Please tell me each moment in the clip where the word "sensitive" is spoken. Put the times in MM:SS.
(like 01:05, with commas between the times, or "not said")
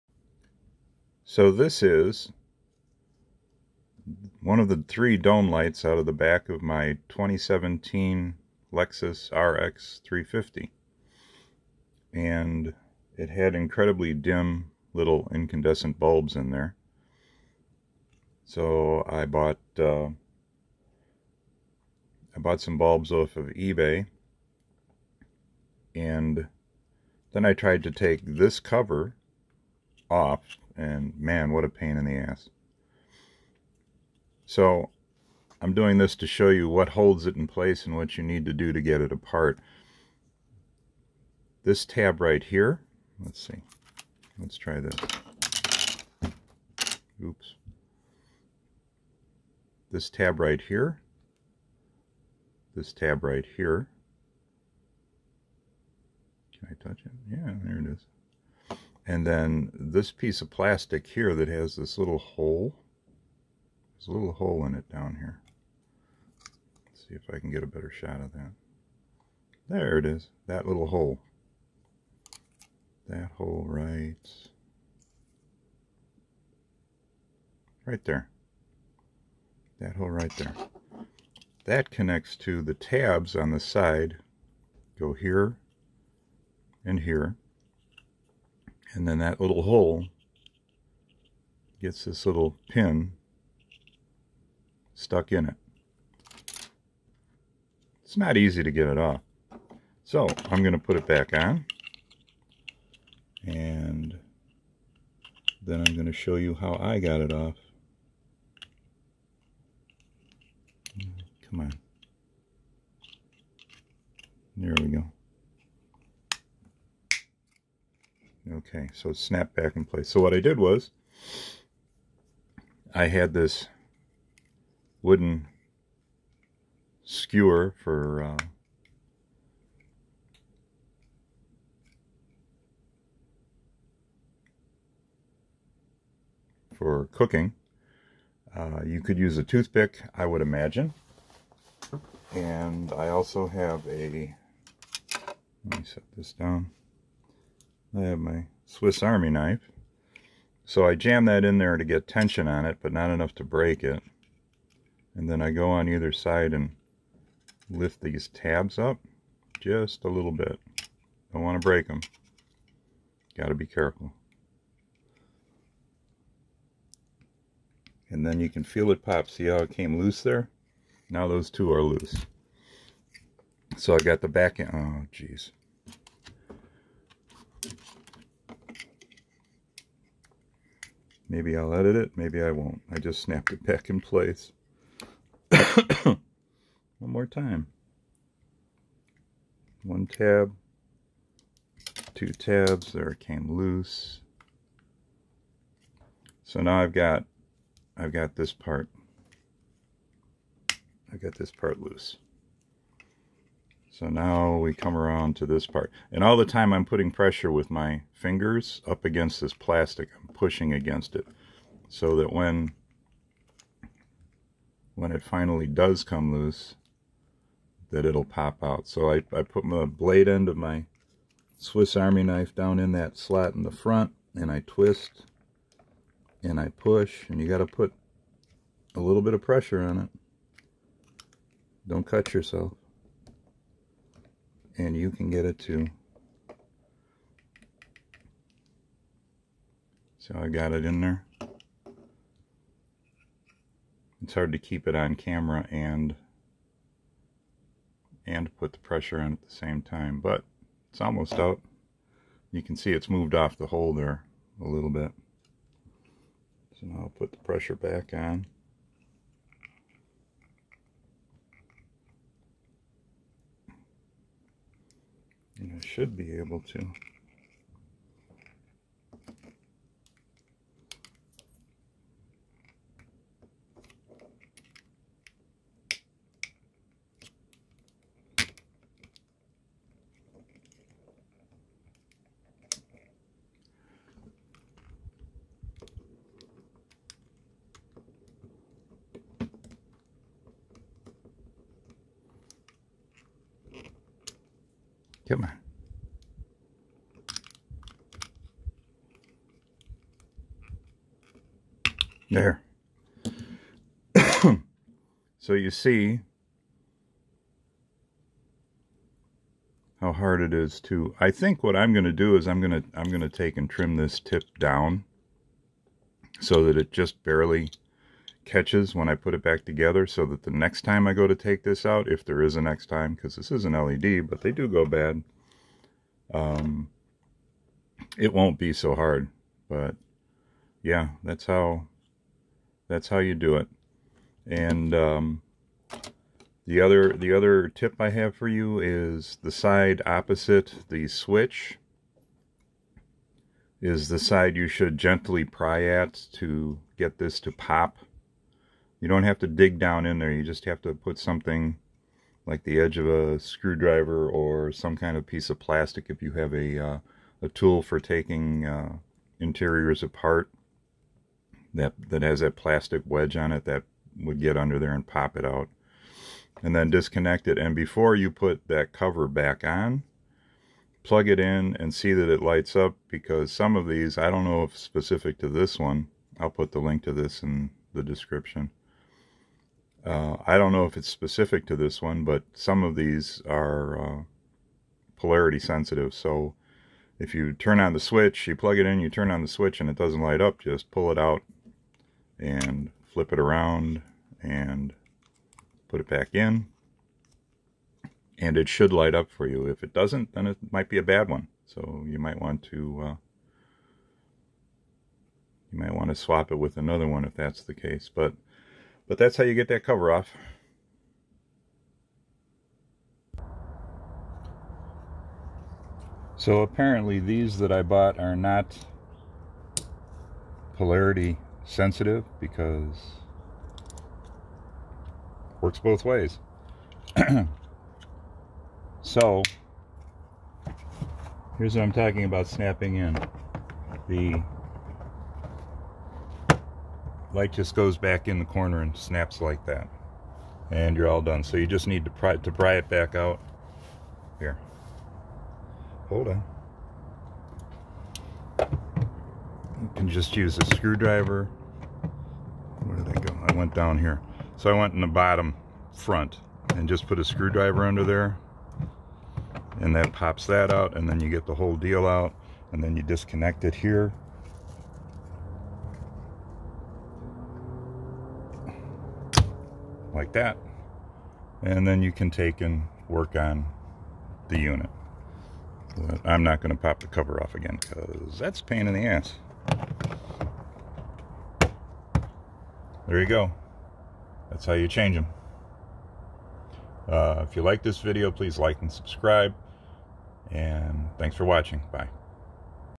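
06:25, 07:01.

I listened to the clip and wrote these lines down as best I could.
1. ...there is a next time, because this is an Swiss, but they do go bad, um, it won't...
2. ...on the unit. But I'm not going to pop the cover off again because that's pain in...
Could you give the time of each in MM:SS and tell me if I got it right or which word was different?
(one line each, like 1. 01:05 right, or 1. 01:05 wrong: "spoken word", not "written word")
1. 05:22 wrong: "LED", not "Swiss"
2. 07:53 right.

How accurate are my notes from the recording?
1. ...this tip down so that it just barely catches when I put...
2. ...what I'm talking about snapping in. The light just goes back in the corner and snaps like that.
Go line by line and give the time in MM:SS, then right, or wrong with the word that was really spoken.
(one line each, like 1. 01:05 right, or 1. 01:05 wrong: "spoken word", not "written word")
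1. 05:13 right
2. 07:11 right.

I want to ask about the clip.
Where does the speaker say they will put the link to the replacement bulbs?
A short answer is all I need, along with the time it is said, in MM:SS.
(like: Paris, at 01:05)
in the description, at 06:17.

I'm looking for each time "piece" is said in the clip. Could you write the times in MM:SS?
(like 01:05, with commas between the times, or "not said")
01:00, 05:55.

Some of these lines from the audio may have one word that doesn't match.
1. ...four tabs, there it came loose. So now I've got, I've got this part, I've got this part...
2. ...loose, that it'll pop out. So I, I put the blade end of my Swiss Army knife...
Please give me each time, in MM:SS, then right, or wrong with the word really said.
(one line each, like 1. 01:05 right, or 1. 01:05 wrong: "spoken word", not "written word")
1. 03:12 wrong: "two", not "four"
2. 03:36 right.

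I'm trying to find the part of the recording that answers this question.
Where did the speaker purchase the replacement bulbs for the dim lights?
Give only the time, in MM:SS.
00:23.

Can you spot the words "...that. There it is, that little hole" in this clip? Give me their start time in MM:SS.
01:08.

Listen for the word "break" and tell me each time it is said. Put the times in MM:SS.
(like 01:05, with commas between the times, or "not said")
02:33, 02:41.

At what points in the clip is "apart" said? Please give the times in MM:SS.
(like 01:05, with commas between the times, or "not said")
00:39, 06:00.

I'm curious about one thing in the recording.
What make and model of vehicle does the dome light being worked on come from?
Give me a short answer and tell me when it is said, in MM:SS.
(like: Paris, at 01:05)
Lexus RX 350, at 00:08.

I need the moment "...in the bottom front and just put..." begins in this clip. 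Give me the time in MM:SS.
07:34.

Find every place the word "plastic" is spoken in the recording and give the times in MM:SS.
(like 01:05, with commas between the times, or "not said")
01:00, 03:29, 05:55, 06:02.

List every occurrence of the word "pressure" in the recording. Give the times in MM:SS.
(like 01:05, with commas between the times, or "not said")
03:27, 03:49, 04:08, 04:17.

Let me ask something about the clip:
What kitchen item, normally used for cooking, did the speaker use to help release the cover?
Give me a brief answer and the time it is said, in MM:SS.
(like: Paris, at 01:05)
wooden skewer, at 02:05.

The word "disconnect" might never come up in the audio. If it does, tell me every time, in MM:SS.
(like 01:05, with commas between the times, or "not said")
06:06, 07:43.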